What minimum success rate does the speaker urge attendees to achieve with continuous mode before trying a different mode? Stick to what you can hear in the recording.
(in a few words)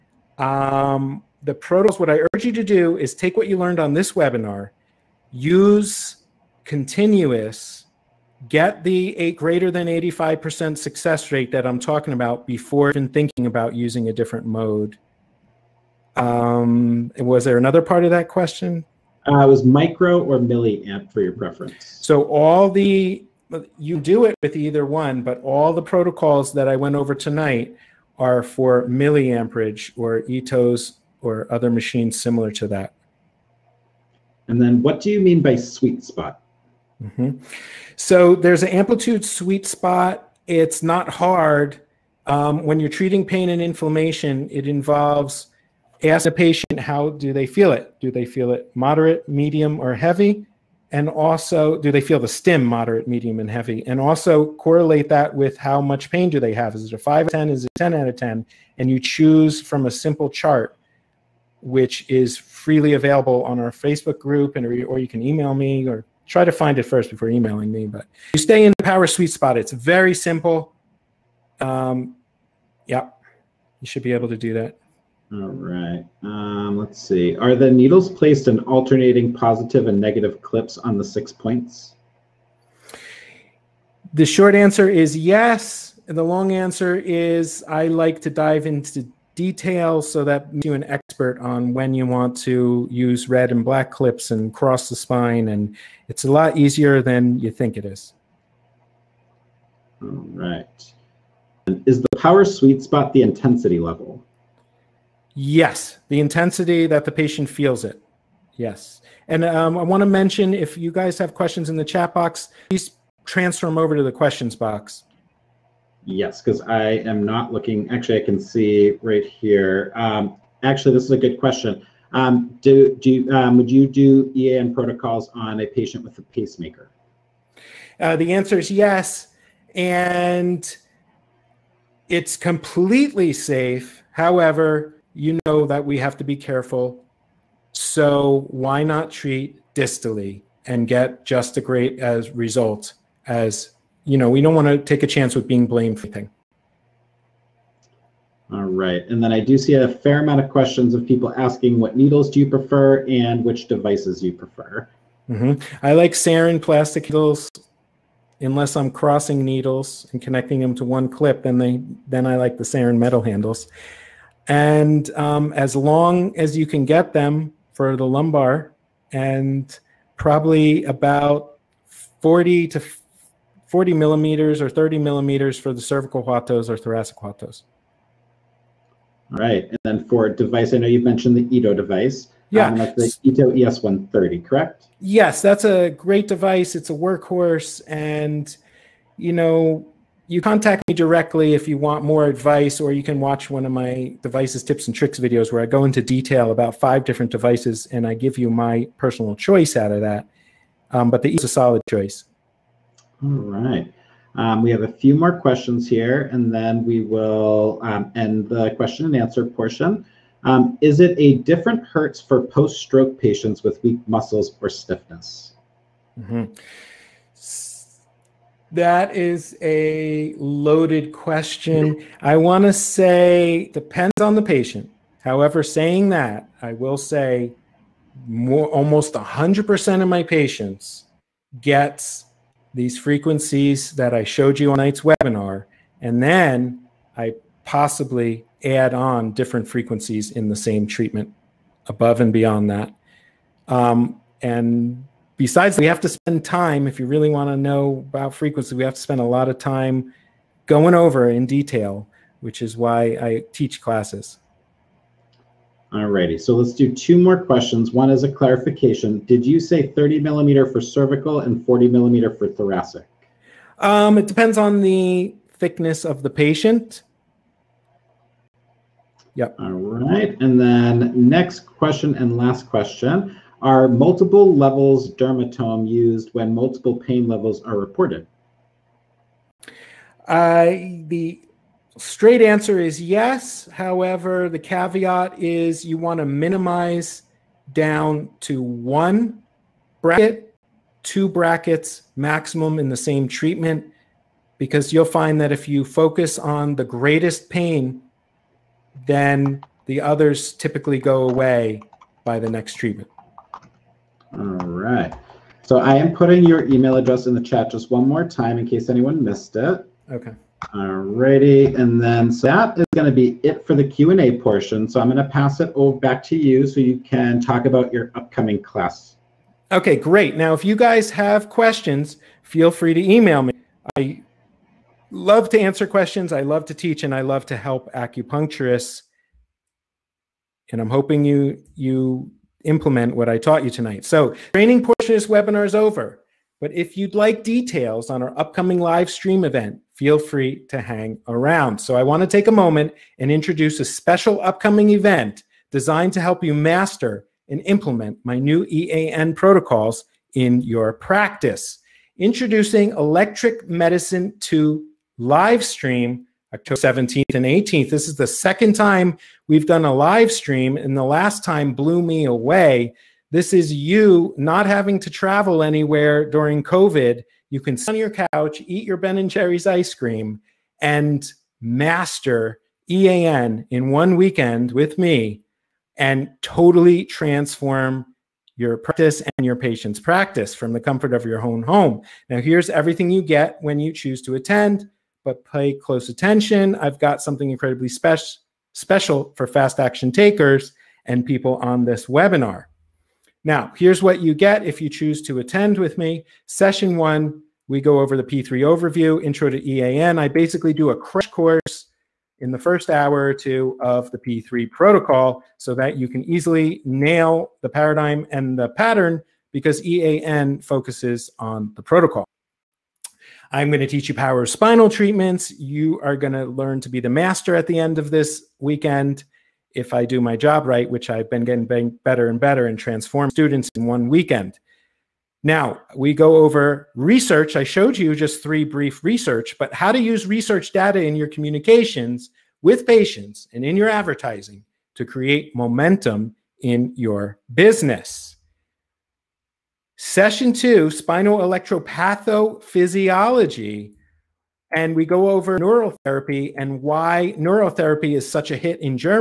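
85%.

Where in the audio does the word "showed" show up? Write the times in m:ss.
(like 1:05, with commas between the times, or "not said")
3:54, 7:07.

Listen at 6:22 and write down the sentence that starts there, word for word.
Now, here's everything you get when you choose to attend, but pay close attention.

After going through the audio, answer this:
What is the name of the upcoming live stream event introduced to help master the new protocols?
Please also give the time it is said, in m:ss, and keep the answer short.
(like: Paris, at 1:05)
Electric Medicine, at 5:52.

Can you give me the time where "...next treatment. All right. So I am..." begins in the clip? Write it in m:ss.
5:02.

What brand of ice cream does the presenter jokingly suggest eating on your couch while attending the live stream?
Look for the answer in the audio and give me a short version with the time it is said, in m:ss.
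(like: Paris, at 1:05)
Ben and Jerry's, at 6:08.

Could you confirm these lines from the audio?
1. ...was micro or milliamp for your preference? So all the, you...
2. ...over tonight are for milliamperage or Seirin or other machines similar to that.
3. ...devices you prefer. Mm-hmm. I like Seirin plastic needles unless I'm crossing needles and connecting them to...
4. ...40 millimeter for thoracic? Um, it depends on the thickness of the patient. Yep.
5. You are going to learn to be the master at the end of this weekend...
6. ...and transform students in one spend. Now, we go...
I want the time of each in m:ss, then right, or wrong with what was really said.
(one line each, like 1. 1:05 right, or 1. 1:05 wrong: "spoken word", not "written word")
1. 0:19 right
2. 0:26 wrong: "ETOs", not "Seirin"
3. 2:33 right
4. 4:21 right
5. 6:55 right
6. 7:02 wrong: "weekend", not "spend".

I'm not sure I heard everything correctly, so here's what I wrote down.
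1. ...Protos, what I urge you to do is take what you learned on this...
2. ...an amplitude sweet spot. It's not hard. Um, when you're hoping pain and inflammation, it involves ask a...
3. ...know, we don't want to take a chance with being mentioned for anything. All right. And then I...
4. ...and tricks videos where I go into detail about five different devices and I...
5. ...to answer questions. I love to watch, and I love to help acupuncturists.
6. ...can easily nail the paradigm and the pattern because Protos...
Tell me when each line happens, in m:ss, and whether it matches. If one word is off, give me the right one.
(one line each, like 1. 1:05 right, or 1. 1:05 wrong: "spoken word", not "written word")
1. 0:01 right
2. 0:38 wrong: "treating", not "hoping"
3. 2:24 wrong: "blamed", not "mentioned"
4. 3:14 right
5. 5:25 wrong: "teach", not "watch"
6. 6:46 wrong: "EAN", not "Protos".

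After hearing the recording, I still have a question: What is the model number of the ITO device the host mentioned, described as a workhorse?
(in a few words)
ES130.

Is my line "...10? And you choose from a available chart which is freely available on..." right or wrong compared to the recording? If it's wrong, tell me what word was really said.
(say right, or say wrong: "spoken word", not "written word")
wrong: "simple", not "available".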